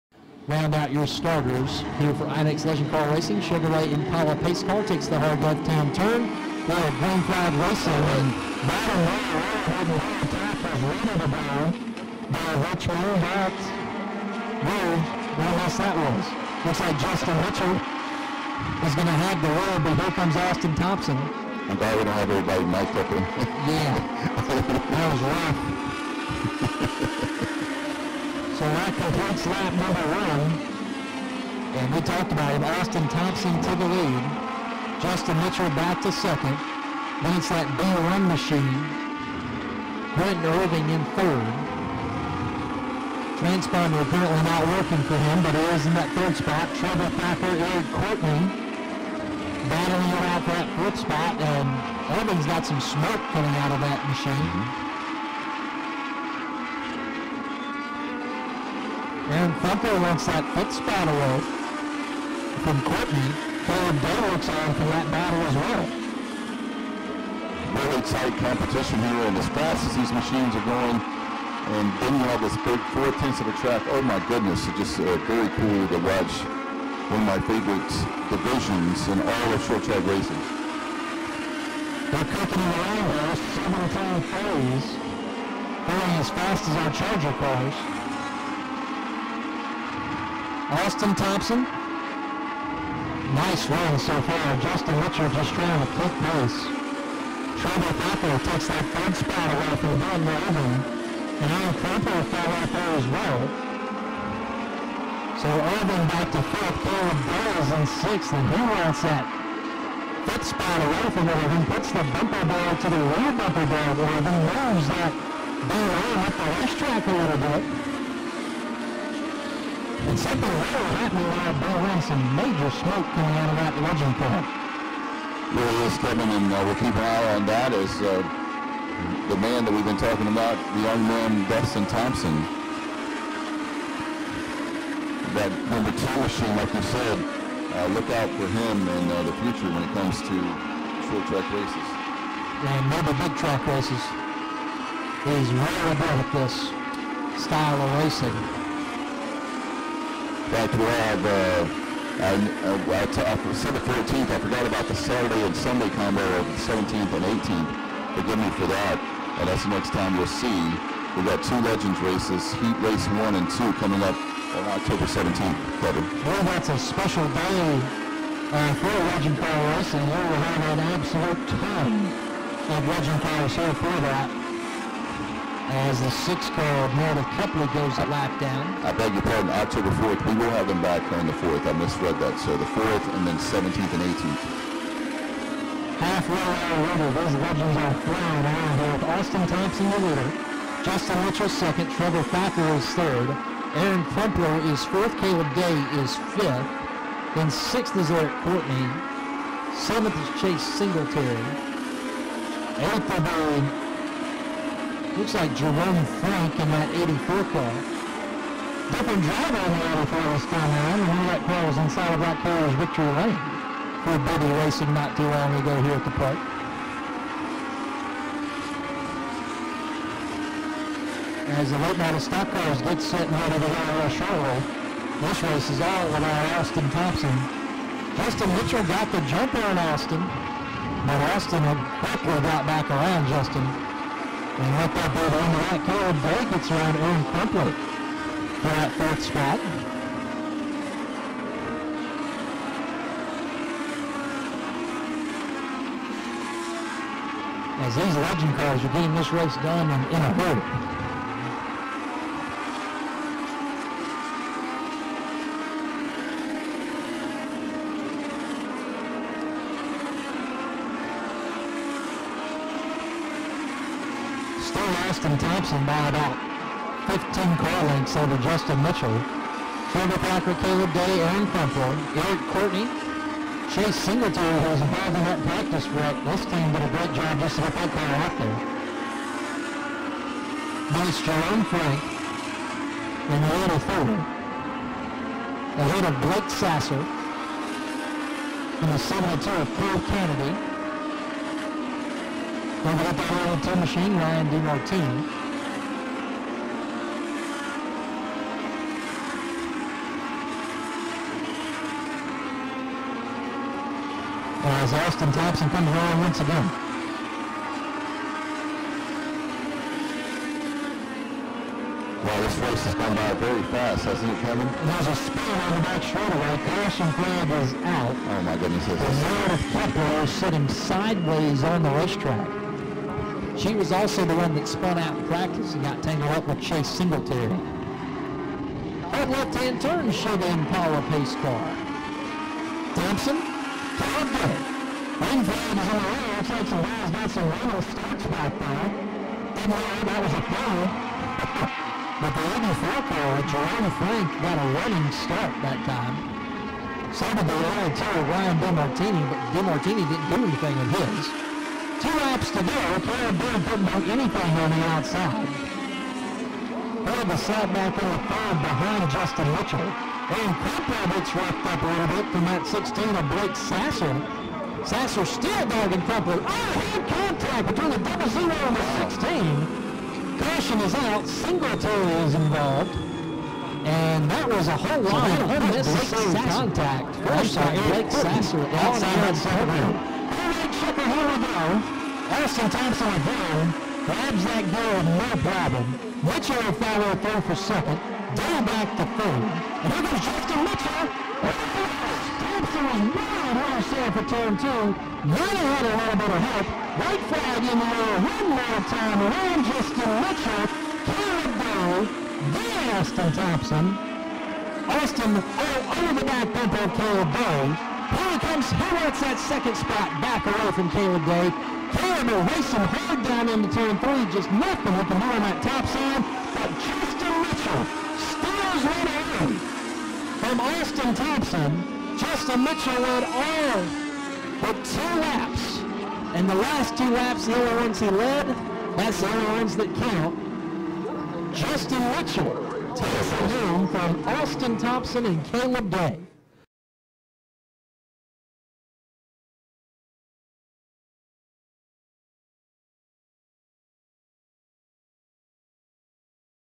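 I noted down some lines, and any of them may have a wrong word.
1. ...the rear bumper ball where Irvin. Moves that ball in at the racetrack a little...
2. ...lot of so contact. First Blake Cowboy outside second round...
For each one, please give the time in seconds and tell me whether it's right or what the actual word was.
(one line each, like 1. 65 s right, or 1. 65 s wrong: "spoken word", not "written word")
1. 112 s right
2. 375 s wrong: "Sasser", not "Cowboy".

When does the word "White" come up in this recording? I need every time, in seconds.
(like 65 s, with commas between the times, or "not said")
397 s.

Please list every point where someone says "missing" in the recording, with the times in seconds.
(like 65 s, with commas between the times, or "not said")
not said.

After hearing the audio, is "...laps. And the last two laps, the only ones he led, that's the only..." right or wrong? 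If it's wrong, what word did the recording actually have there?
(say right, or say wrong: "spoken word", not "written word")
right.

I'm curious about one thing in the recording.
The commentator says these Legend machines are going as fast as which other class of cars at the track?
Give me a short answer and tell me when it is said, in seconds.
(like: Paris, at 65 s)
Charger cars, at 86 s.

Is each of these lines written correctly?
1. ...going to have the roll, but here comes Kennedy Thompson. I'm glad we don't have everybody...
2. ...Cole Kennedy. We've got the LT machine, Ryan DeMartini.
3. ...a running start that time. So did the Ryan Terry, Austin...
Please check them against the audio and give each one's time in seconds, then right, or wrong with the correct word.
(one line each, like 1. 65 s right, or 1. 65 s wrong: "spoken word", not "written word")
1. 18 s wrong: "Austin", not "Kennedy"
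2. 289 s right
3. 344 s wrong: "Ryan", not "Austin".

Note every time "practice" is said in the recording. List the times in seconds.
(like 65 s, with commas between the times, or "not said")
275 s, 325 s.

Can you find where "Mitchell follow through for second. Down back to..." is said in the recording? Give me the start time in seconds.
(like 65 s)
386 s.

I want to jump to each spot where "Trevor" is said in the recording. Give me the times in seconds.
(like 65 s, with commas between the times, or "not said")
46 s, 97 s, 191 s, 269 s.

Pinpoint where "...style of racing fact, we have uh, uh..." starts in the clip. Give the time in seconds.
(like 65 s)
147 s.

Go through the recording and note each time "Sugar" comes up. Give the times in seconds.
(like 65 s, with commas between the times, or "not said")
3 s.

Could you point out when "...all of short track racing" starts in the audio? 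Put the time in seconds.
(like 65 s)
79 s.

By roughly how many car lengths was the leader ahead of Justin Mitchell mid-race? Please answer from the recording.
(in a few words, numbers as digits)
15.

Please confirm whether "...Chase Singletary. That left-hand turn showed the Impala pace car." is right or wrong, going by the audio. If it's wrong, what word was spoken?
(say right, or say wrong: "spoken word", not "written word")
right.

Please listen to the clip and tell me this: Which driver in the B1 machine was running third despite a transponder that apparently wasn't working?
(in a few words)
Brent Irving.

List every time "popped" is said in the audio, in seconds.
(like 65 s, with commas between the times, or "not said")
not said.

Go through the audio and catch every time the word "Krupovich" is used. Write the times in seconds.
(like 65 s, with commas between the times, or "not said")
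360 s, 366 s.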